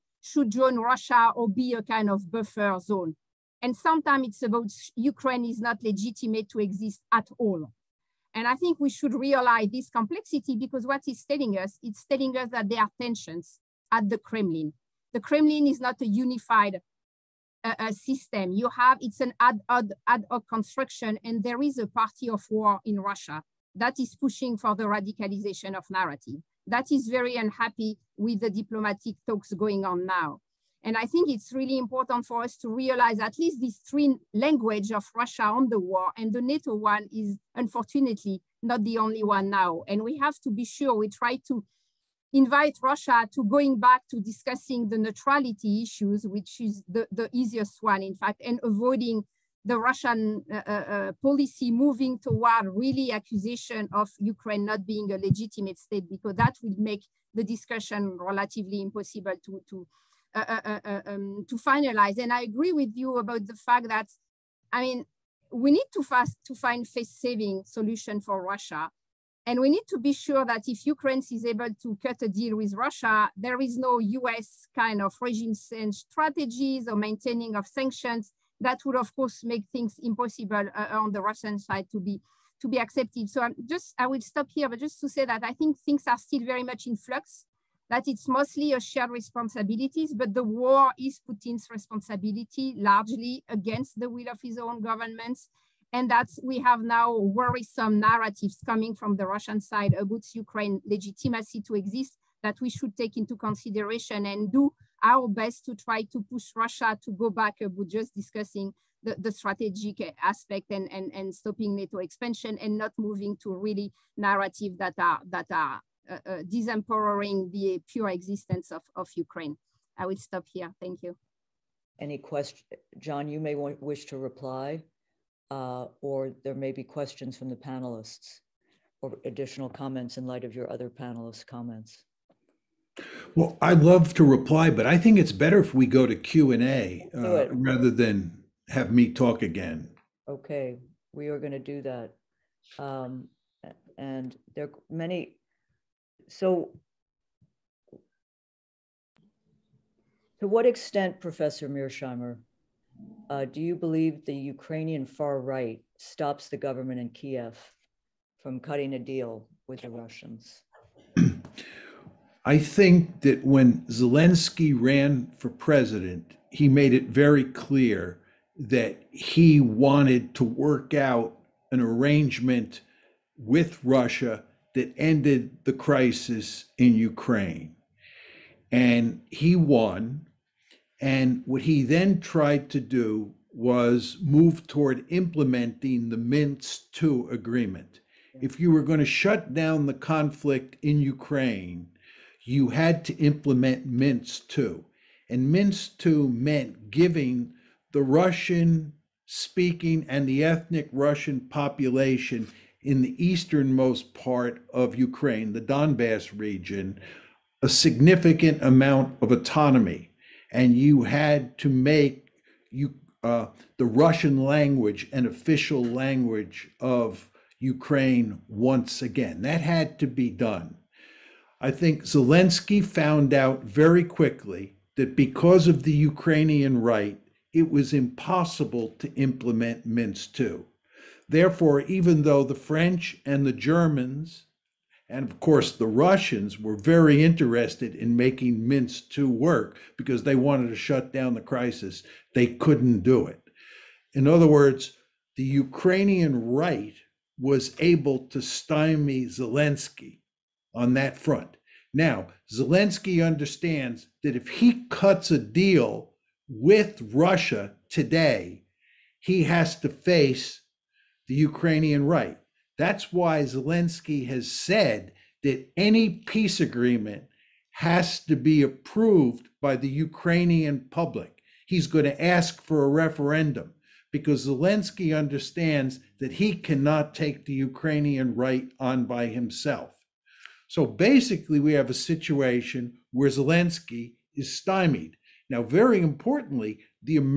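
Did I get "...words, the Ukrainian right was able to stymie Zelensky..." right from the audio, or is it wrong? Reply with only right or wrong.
right.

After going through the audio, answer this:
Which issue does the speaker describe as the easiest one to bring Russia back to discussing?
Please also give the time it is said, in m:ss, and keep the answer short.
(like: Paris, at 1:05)
Neutrality, at 0:44.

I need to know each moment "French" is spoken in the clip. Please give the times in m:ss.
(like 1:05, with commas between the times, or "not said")
3:52.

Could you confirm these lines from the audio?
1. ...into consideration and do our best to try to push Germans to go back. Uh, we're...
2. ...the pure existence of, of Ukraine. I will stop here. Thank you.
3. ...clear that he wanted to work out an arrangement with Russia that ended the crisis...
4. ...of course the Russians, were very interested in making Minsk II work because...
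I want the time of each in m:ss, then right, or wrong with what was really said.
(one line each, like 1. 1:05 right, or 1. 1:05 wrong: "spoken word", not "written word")
1. 1:43 wrong: "Russia", not "Germans"
2. 1:57 right
3. 2:47 right
4. 3:55 right.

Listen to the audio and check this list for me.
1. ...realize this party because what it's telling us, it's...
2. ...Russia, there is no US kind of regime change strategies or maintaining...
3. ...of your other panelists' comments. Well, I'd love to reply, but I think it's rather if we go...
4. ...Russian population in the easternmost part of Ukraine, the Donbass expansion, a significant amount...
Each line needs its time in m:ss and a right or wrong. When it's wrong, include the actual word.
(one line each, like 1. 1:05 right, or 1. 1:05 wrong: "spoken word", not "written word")
1. 0:09 wrong: "complexity", not "party"
2. 1:12 right
3. 2:10 wrong: "better", not "rather"
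4. 3:20 wrong: "region", not "expansion".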